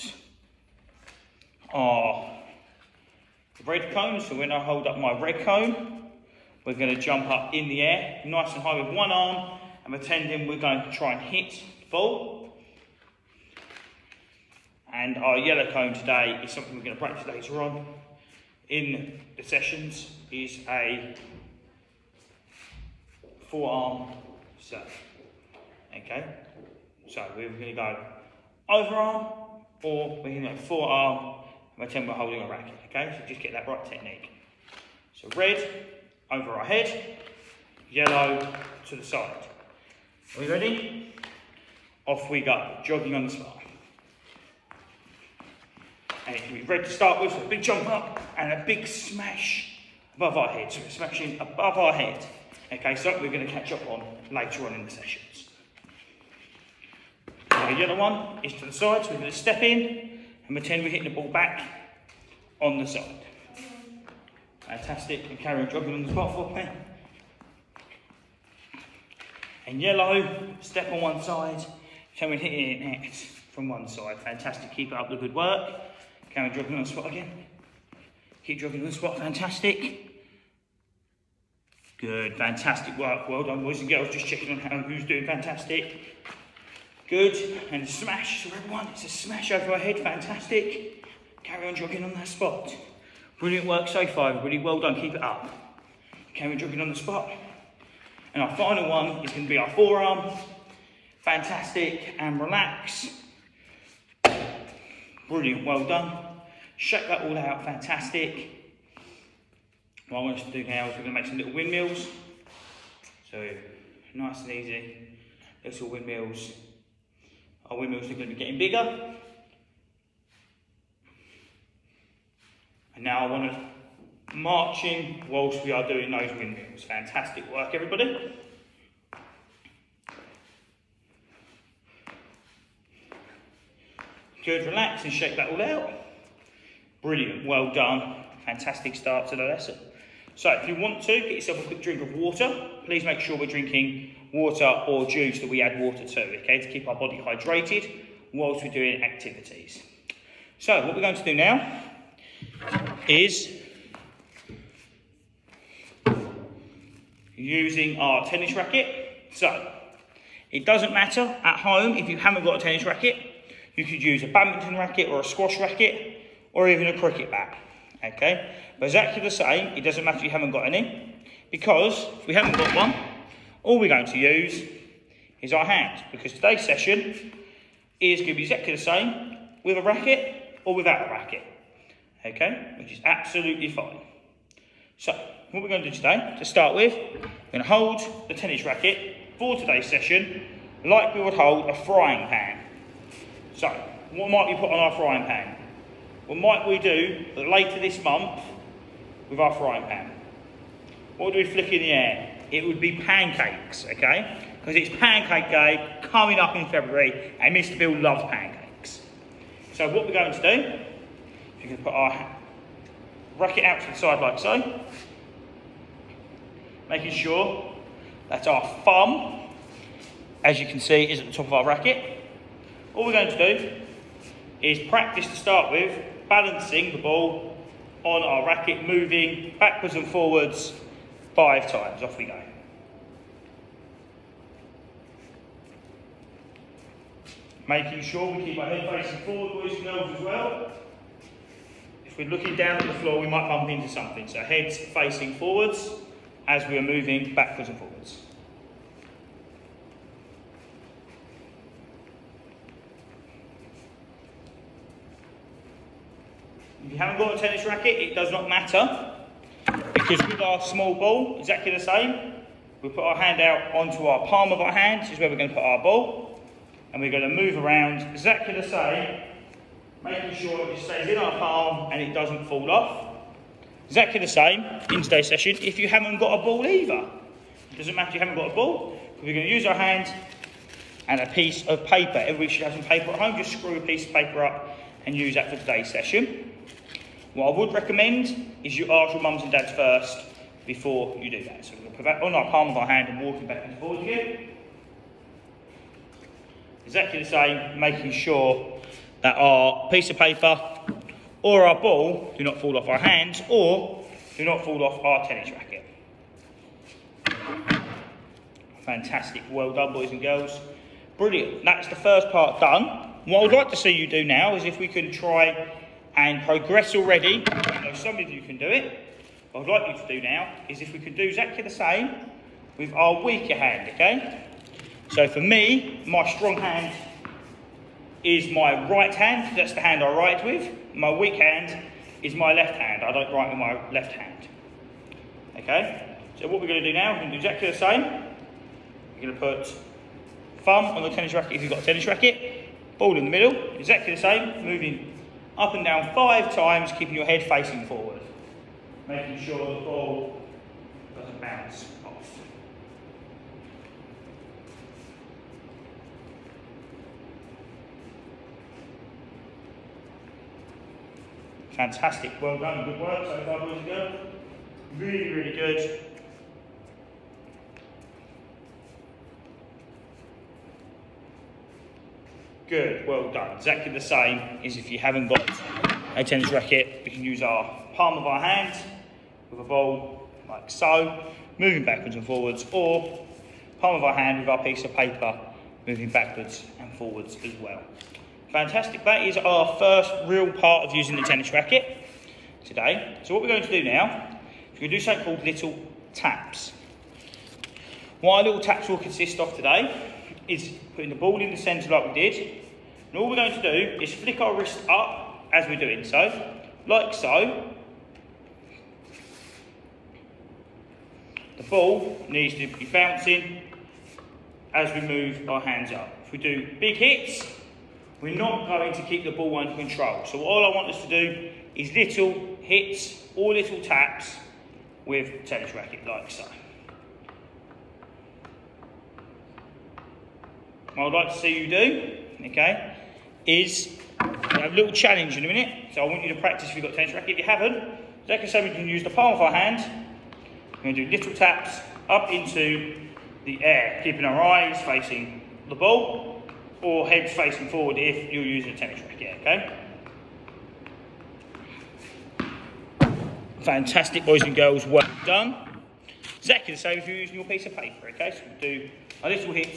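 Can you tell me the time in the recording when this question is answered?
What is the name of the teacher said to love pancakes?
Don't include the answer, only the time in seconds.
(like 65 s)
207 s.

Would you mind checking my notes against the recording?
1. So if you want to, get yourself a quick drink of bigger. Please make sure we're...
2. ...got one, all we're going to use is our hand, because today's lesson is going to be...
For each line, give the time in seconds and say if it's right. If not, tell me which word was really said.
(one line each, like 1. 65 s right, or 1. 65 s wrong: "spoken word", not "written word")
1. 140 s wrong: "water", not "bigger"
2. 172 s wrong: "session", not "lesson".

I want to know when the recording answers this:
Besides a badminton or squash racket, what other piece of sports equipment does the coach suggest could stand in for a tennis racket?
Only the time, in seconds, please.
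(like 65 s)
166 s.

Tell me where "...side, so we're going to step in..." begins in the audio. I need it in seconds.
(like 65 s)
58 s.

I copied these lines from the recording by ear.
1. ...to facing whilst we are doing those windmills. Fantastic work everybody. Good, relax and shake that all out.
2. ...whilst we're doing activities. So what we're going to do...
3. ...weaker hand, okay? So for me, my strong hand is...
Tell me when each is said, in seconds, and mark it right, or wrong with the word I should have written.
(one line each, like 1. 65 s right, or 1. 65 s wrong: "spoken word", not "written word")
1. 123 s wrong: "marching", not "facing"
2. 148 s right
3. 323 s right.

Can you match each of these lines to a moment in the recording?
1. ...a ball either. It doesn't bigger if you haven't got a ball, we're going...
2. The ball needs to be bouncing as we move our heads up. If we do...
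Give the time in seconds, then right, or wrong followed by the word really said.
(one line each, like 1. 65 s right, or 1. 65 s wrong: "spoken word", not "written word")
1. 276 s wrong: "matter", not "bigger"
2. 411 s wrong: "hands", not "heads".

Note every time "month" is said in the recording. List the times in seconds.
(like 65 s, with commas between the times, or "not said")
198 s.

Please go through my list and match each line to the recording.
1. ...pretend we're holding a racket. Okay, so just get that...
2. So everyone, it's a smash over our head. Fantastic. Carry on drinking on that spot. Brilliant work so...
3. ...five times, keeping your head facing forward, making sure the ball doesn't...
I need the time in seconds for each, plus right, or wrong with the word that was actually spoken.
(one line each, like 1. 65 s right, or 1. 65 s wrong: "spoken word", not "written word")
1. 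31 s right
2. 88 s wrong: "jogging", not "drinking"
3. 346 s right.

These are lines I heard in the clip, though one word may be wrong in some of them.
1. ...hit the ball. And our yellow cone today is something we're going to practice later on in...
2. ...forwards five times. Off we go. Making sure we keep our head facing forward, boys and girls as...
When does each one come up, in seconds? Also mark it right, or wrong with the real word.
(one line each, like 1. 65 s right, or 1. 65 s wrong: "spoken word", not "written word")
1. 11 s right
2. 230 s right.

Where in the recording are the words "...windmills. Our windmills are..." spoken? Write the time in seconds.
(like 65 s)
115 s.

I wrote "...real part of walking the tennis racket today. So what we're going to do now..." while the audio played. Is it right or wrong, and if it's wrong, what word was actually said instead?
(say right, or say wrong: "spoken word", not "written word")
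wrong: "using", not "walking".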